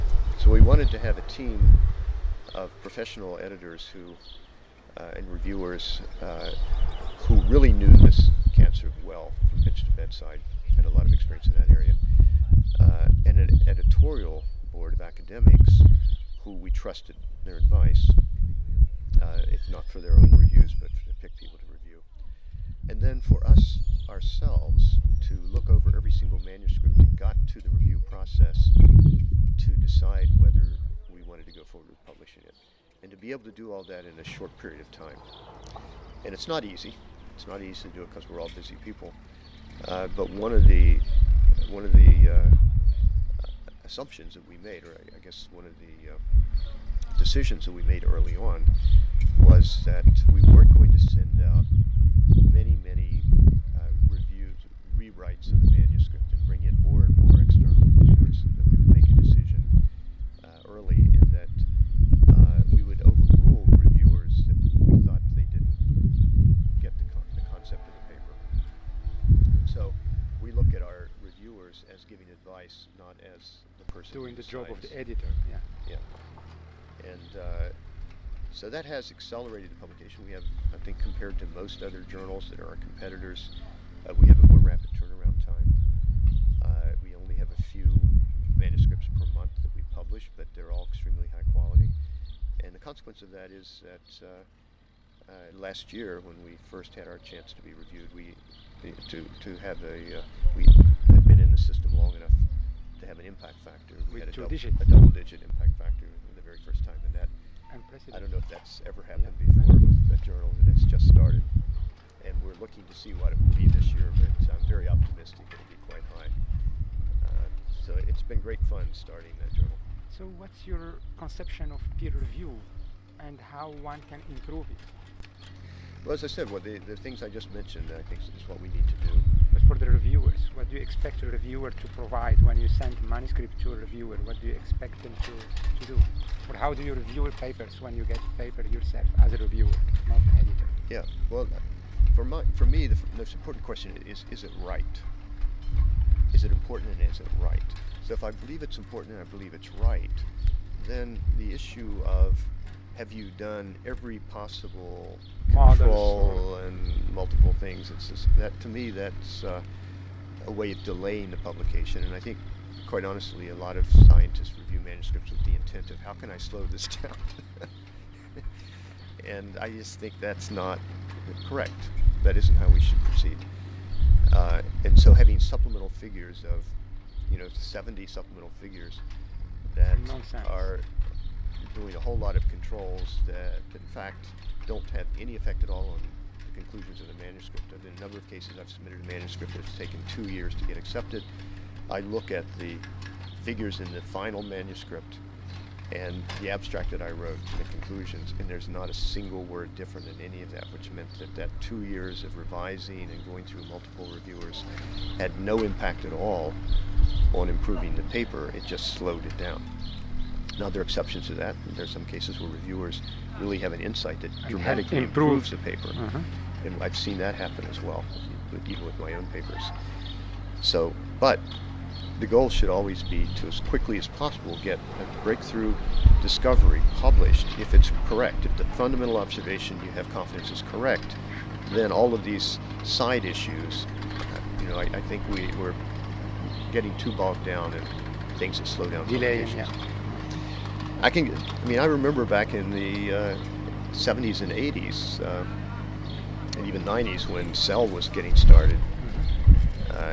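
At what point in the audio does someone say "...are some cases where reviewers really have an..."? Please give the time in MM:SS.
03:31.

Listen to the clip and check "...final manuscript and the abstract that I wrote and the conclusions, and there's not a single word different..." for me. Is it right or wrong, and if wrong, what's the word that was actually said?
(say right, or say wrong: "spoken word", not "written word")
right.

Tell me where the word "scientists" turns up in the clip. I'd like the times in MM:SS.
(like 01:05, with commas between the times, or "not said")
02:44.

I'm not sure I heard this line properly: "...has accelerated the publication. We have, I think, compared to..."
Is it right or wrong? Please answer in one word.
right.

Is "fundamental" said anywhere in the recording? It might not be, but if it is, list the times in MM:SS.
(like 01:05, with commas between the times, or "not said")
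03:48.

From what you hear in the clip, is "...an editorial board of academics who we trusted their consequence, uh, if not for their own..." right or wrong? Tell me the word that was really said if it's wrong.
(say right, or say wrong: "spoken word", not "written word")
wrong: "advice", not "consequence".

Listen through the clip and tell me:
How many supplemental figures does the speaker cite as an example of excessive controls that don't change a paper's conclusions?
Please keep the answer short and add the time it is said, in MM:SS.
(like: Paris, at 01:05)
70, at 02:57.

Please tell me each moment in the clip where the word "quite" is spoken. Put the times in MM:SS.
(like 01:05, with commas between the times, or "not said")
01:55, 02:42.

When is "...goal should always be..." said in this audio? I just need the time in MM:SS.
03:42.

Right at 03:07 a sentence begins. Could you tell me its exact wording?
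in a number of cases I've submitted a manuscript that's taken two years to get accepted.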